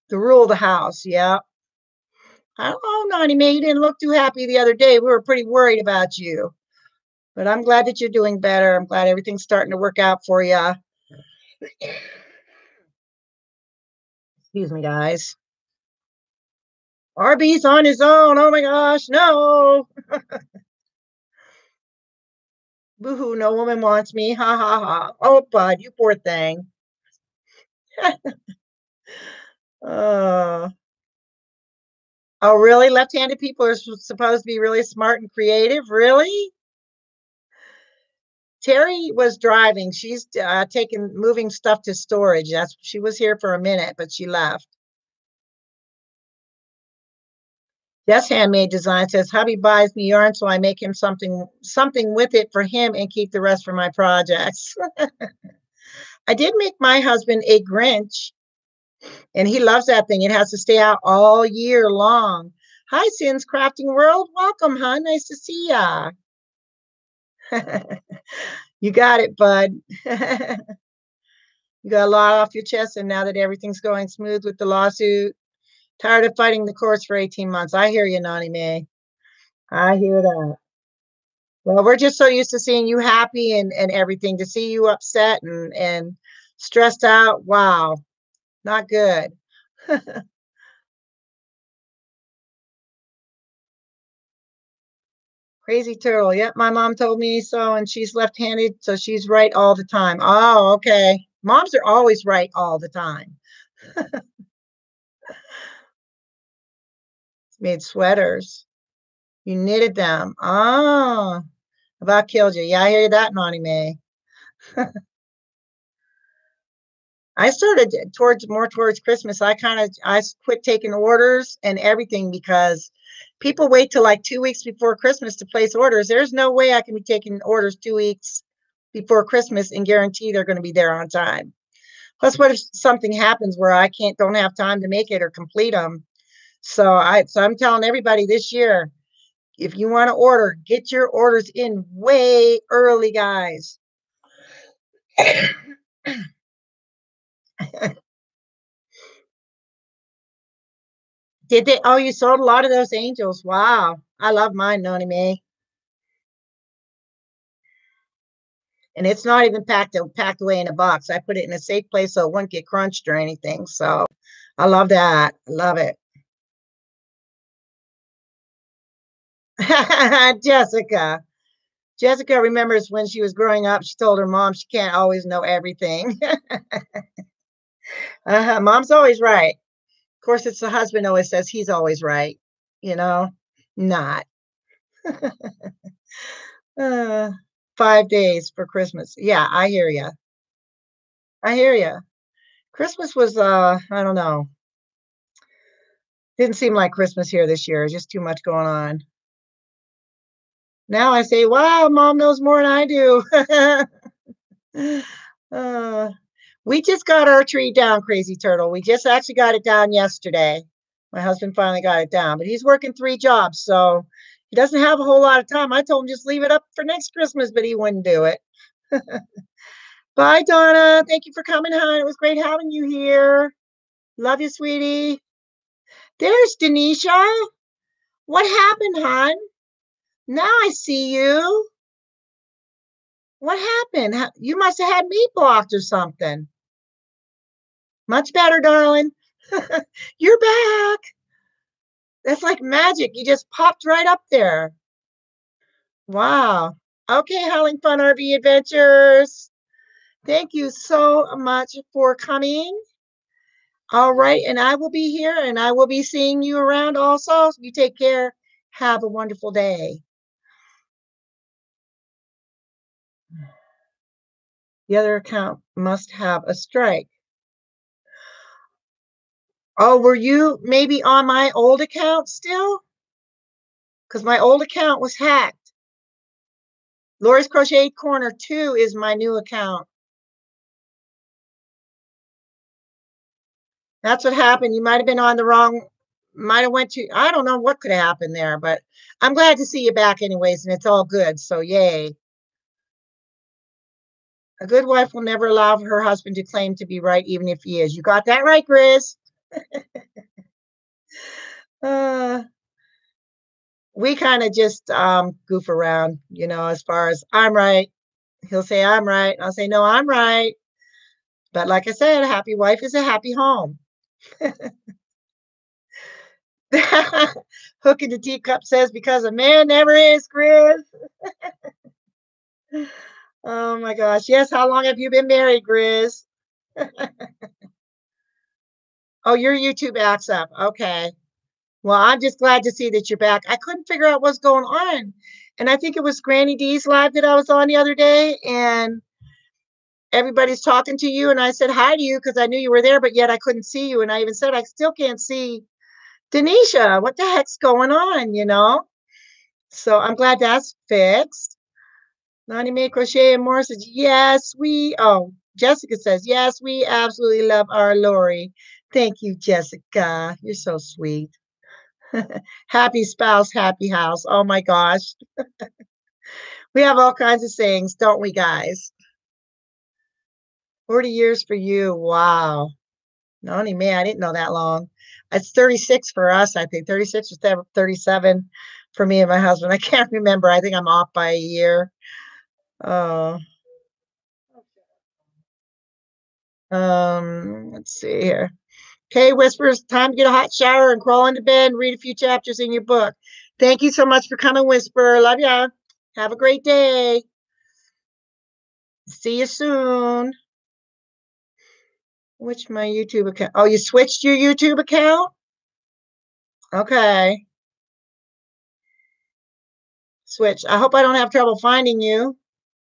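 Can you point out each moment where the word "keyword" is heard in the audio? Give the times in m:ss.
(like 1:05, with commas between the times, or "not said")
not said.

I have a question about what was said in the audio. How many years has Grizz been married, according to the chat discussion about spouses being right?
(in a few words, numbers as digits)
40.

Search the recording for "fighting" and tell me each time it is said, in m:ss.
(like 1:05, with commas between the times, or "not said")
1:16.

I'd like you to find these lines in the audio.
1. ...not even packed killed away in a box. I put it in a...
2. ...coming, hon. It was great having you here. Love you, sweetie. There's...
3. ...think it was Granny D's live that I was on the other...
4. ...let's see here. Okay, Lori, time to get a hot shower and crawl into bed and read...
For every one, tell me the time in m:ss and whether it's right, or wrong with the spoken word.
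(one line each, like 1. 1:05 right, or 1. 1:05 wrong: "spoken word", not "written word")
1. 2:39 wrong: "packed", not "killed"
2. 3:41 right
3. 5:35 right
4. 6:27 wrong: "Whispers", not "Lori".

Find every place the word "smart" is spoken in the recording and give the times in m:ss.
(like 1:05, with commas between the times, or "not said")
0:34.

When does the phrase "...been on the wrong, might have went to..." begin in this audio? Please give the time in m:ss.
4:45.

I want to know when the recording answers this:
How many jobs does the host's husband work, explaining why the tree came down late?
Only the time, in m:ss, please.
3:32.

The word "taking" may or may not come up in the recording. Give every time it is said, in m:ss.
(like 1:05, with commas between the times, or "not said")
0:40, 2:00, 2:07.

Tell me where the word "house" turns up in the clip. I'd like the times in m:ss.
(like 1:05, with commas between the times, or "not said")
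0:00, 6:03.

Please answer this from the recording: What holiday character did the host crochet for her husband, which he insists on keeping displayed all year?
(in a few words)
Grinch.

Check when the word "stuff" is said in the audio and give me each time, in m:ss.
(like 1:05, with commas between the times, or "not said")
0:41.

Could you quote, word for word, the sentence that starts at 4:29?
Oh, were you maybe on my old account still?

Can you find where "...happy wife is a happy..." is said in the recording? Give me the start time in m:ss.
5:12.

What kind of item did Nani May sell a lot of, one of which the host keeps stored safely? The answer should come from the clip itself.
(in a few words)
angels.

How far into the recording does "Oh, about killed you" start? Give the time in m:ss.
1:50.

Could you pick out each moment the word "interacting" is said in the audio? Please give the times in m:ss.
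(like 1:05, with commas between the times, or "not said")
not said.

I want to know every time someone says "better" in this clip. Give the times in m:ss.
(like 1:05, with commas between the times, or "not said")
0:08, 3:58.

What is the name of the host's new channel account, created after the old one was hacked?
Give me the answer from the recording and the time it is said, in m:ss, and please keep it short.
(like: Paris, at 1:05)
Lori's Crochet Corner 2, at 4:37.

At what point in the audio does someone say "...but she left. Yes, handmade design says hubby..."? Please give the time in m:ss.
0:43.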